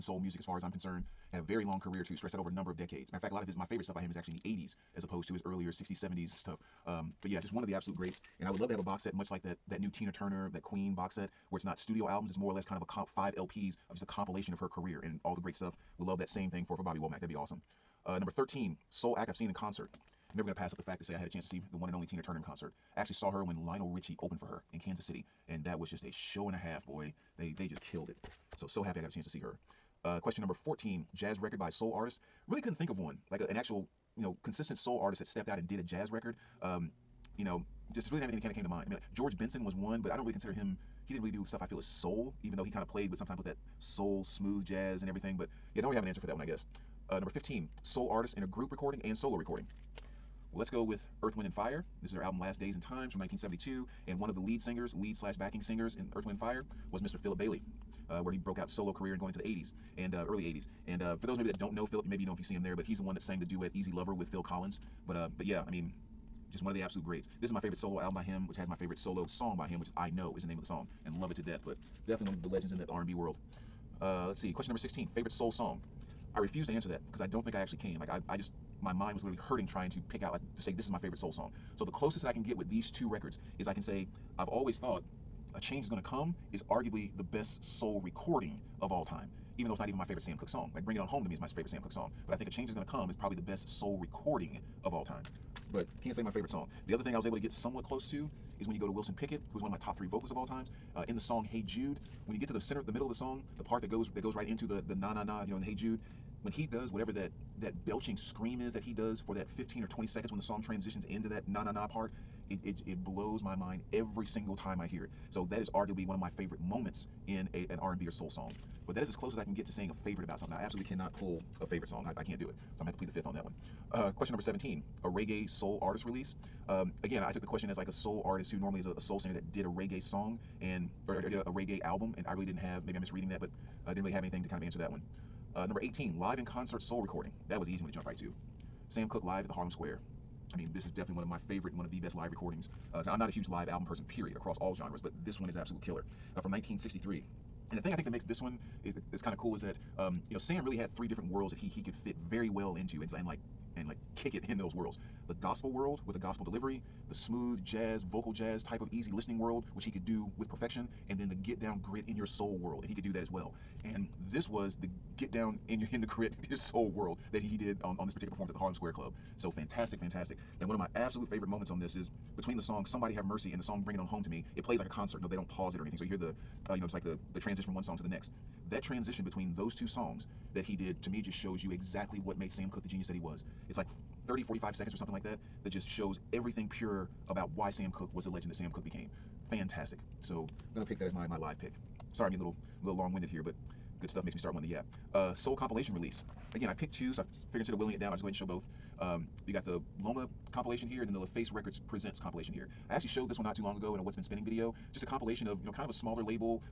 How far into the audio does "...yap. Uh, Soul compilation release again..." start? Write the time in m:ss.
3:14.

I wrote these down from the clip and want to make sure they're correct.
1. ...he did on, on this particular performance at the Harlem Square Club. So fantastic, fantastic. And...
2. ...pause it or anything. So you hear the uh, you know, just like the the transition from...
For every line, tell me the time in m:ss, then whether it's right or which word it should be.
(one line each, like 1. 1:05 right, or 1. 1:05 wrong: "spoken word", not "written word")
1. 2:47 right
2. 2:55 right.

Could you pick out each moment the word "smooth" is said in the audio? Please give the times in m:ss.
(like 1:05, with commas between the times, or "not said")
0:44, 2:37.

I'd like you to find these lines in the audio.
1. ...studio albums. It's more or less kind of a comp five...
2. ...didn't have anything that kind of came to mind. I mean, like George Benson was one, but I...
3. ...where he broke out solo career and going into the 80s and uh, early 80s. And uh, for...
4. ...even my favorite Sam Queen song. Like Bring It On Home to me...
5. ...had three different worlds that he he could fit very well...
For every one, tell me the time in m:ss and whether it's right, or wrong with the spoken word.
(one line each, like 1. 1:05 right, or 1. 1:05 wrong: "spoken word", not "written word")
1. 0:11 right
2. 0:38 right
3. 0:58 right
4. 1:29 wrong: "Cooke", not "Queen"
5. 2:30 right.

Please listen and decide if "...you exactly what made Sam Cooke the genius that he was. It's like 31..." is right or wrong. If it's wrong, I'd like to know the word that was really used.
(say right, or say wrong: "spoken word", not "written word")
wrong: "30", not "31".